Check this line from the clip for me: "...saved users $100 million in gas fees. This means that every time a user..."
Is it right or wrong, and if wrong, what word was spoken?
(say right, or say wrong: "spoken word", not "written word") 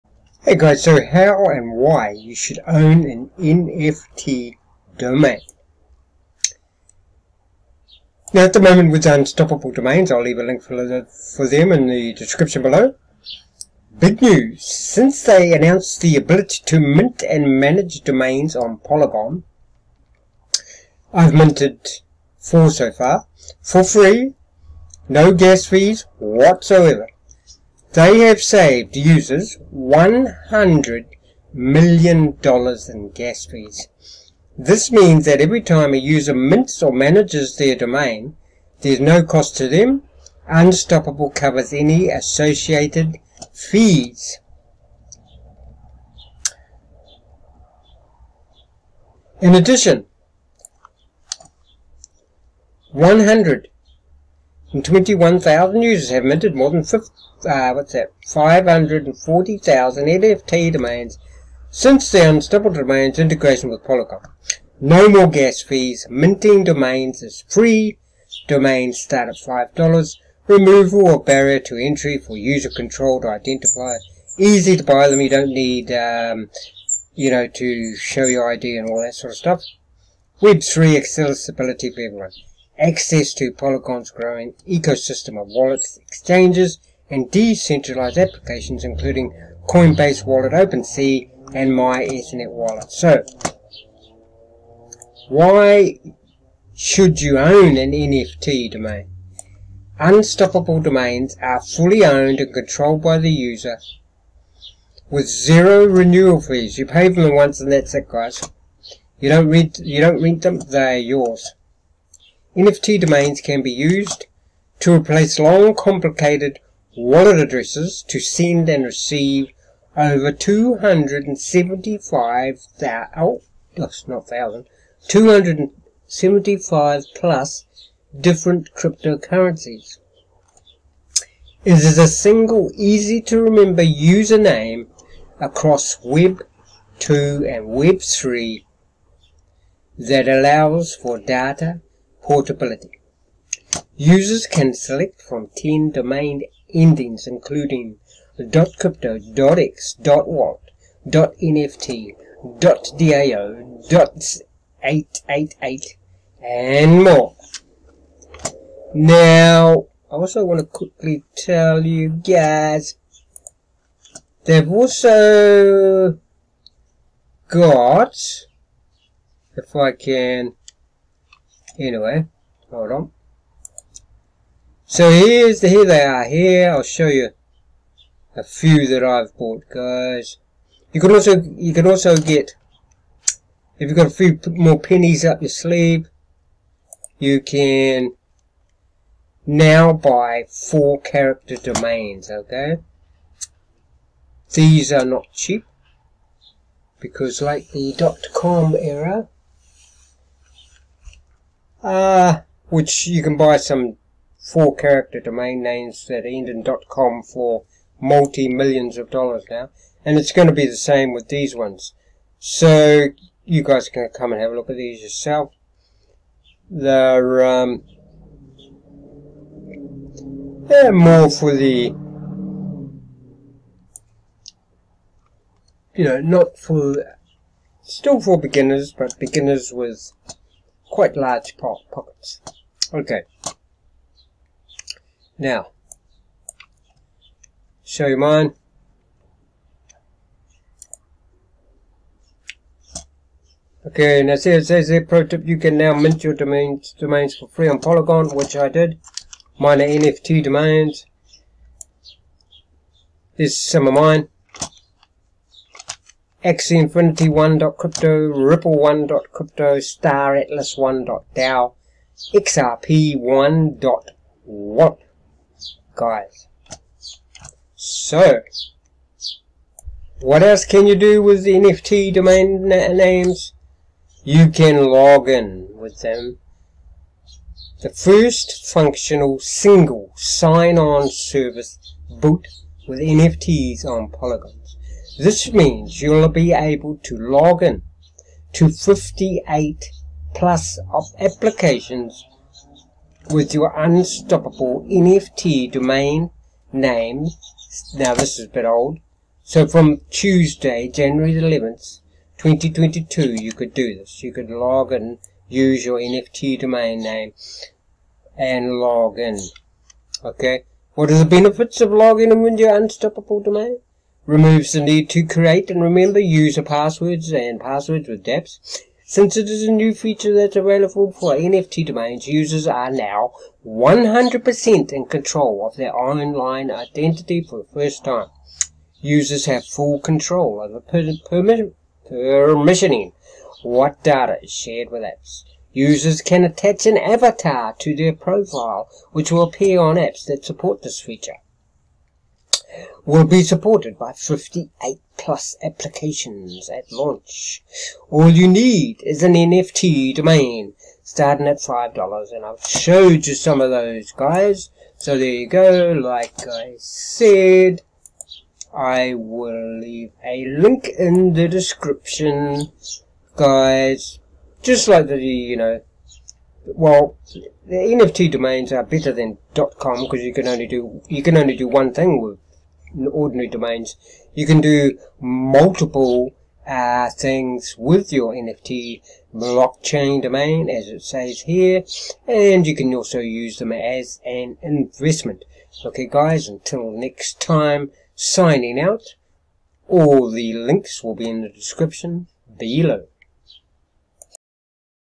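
right.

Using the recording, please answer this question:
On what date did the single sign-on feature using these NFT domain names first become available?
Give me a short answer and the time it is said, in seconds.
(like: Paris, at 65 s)
January 11, 2022, at 300 s.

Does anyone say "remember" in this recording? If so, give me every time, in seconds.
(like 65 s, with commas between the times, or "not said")
133 s, 315 s.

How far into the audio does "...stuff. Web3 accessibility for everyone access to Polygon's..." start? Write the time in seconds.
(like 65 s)
79 s.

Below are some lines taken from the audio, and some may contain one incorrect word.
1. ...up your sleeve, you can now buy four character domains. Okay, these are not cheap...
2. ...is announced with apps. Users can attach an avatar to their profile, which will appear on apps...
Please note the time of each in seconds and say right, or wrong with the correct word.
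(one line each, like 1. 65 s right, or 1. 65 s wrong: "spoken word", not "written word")
1. 185 s right
2. 334 s wrong: "shared", not "announced".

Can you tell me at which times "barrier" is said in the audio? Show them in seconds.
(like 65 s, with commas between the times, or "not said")
71 s.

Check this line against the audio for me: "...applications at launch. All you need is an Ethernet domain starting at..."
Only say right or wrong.
wrong.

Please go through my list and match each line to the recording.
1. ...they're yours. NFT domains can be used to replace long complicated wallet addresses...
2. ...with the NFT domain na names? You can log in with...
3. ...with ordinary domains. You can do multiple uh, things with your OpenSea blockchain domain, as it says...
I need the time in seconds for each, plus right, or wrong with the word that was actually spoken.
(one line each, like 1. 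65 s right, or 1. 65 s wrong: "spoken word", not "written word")
1. 110 s right
2. 271 s right
3. 372 s wrong: "NFT", not "OpenSea".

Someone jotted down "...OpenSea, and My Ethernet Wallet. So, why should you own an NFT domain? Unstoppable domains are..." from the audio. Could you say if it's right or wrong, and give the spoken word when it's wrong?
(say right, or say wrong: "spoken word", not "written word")
right.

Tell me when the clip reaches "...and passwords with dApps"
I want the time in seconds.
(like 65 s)
317 s.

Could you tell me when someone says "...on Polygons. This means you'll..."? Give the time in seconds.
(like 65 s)
283 s.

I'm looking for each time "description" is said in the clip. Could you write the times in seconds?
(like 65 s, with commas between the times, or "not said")
12 s, 361 s, 391 s.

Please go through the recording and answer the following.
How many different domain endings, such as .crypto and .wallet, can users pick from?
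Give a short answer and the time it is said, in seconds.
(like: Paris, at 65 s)
10, at 145 s.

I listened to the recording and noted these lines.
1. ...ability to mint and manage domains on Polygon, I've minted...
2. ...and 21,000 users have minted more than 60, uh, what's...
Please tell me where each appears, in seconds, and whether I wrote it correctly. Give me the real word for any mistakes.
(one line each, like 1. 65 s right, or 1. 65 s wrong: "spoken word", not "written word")
1. 16 s right
2. 54 s wrong: "50", not "60".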